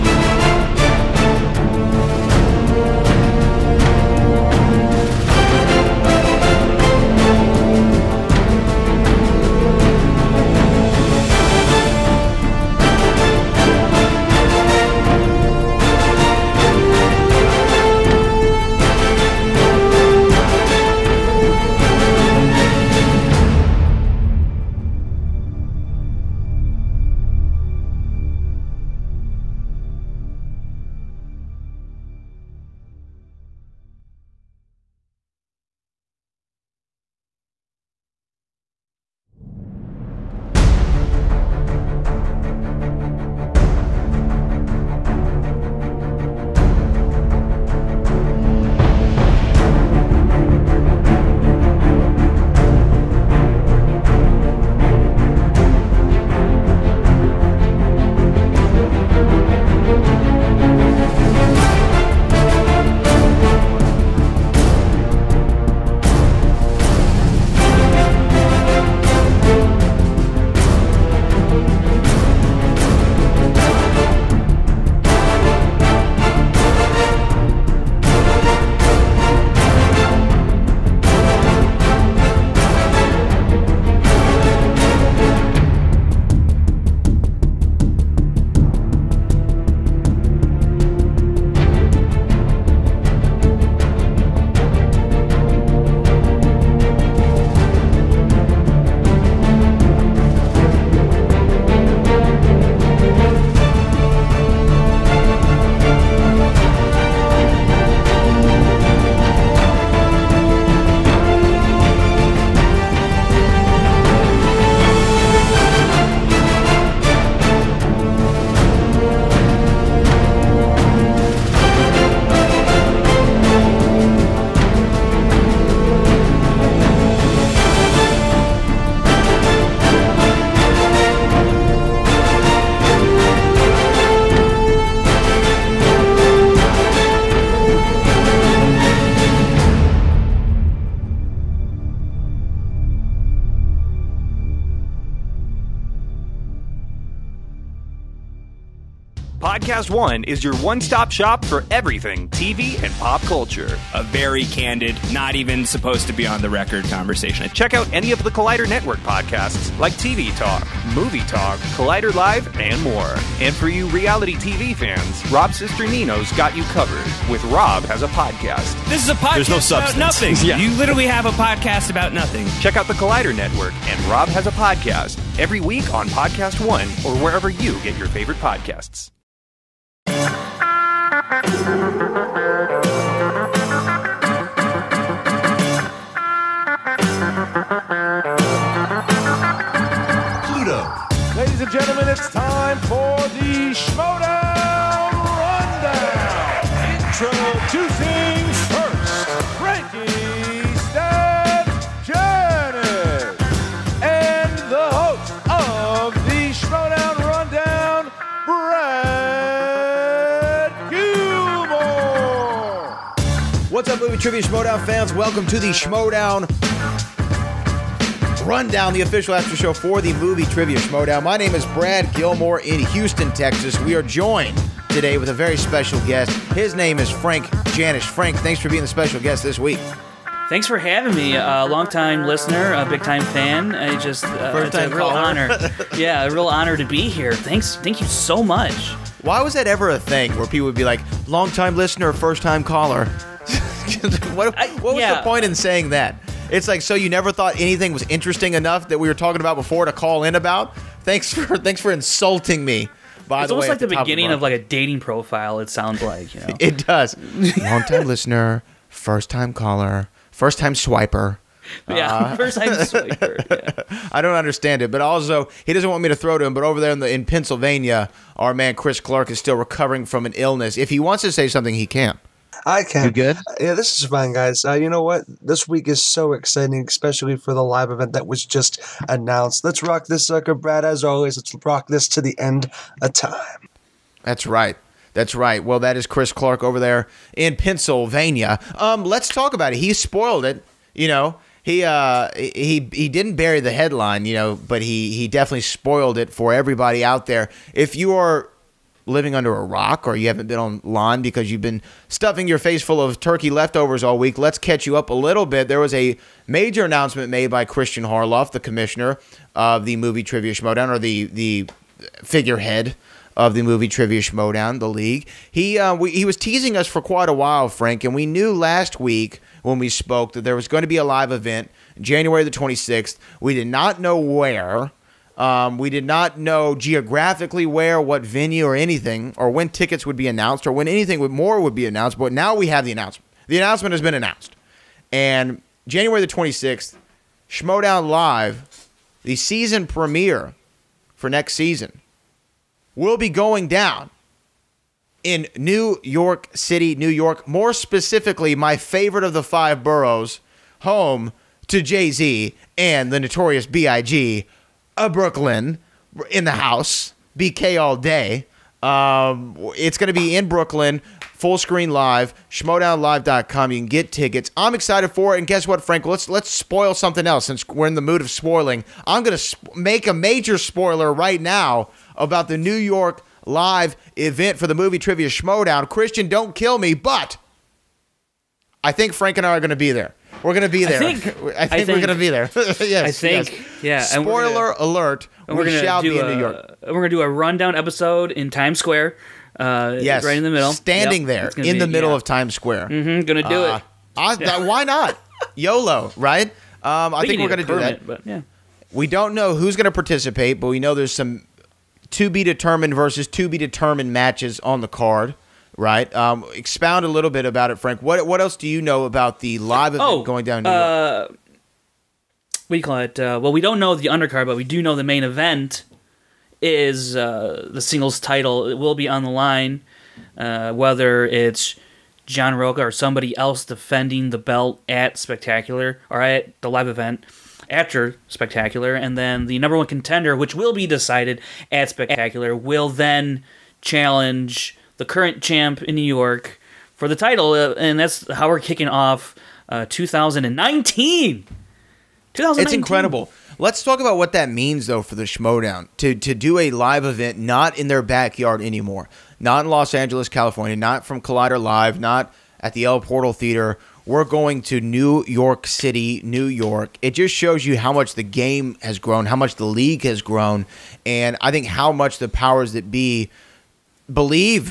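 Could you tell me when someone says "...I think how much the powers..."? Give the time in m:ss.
7:41.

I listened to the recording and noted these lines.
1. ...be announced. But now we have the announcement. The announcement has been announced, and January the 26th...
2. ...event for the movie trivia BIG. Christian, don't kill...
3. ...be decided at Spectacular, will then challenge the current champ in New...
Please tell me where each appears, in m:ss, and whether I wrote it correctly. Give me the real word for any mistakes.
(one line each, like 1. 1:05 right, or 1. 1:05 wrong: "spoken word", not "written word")
1. 5:31 right
2. 6:14 wrong: "Schmoedown", not "BIG"
3. 7:10 right.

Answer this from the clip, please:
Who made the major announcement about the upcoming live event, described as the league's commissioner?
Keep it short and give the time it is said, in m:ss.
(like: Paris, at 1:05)
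Christian Harloff, at 5:07.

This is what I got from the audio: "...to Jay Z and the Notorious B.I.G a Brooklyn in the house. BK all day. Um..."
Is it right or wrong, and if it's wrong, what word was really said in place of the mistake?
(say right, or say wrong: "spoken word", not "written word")
right.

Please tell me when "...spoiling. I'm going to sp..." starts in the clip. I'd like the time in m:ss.
6:08.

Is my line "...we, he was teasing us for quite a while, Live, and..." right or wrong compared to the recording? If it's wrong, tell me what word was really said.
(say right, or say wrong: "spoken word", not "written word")
wrong: "Frank", not "Live".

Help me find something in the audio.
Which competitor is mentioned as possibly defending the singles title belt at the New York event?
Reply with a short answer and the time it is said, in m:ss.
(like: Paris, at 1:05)
John Rocha, at 7:02.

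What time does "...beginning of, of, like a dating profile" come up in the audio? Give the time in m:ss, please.
4:13.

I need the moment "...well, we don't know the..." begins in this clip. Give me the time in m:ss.
6:53.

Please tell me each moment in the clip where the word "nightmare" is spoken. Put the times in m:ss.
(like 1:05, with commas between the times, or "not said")
not said.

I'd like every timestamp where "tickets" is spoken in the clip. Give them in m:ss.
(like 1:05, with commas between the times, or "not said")
5:29, 6:04.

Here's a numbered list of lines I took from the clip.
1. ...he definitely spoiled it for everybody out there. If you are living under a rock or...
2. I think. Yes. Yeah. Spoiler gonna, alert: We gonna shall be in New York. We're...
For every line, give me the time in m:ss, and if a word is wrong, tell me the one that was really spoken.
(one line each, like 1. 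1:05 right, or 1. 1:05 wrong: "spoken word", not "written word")
1. 4:55 right
2. 6:22 right.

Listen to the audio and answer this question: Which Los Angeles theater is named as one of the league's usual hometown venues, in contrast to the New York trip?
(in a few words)
El Portal Theater.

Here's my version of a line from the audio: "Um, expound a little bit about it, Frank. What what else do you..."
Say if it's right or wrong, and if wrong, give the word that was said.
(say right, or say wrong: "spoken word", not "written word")
right.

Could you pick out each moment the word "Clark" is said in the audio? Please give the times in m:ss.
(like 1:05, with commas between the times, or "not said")
4:29, 4:46.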